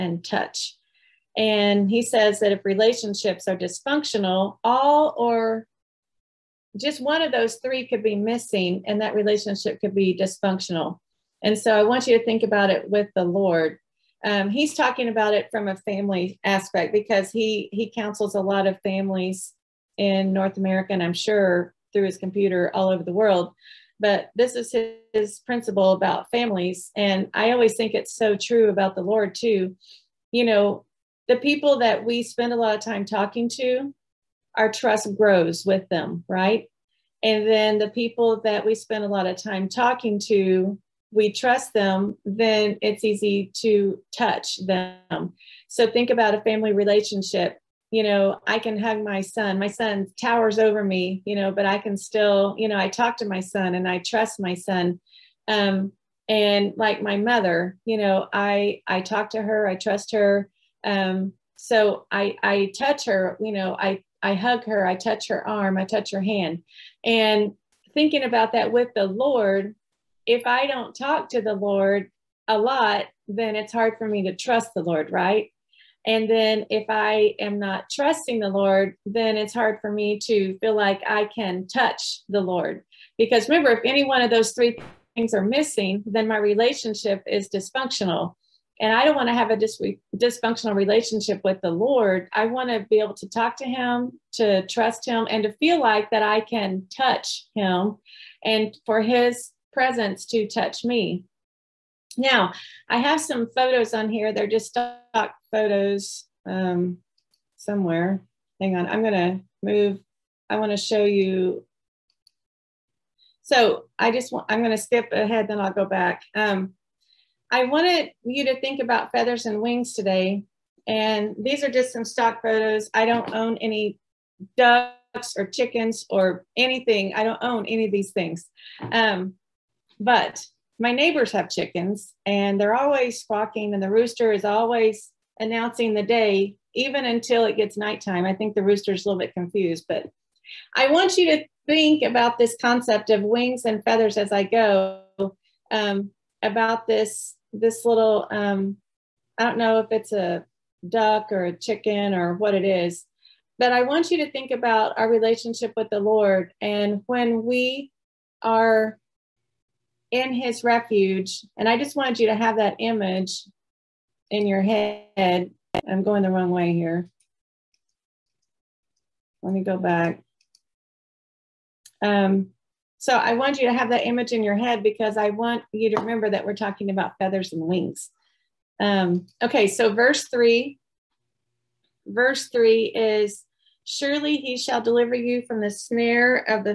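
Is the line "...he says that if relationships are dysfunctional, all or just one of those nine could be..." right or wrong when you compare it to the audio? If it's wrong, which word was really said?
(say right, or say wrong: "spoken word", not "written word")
wrong: "three", not "nine".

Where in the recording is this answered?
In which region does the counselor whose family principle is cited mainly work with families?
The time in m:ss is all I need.
0:20.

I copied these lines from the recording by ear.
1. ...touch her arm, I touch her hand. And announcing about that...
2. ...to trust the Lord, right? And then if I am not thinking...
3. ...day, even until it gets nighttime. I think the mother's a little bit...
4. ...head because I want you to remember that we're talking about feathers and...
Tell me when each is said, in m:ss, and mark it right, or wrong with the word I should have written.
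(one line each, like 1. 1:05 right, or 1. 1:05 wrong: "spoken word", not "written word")
1. 1:04 wrong: "thinking", not "announcing"
2. 1:14 wrong: "trusting", not "thinking"
3. 2:16 wrong: "rooster", not "mother"
4. 2:54 right.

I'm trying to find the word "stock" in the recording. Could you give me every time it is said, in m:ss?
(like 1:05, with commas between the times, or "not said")
1:44, 2:02.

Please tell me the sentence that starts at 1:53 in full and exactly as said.
So I just want, I'm gonna skip ahead, then I'll go back.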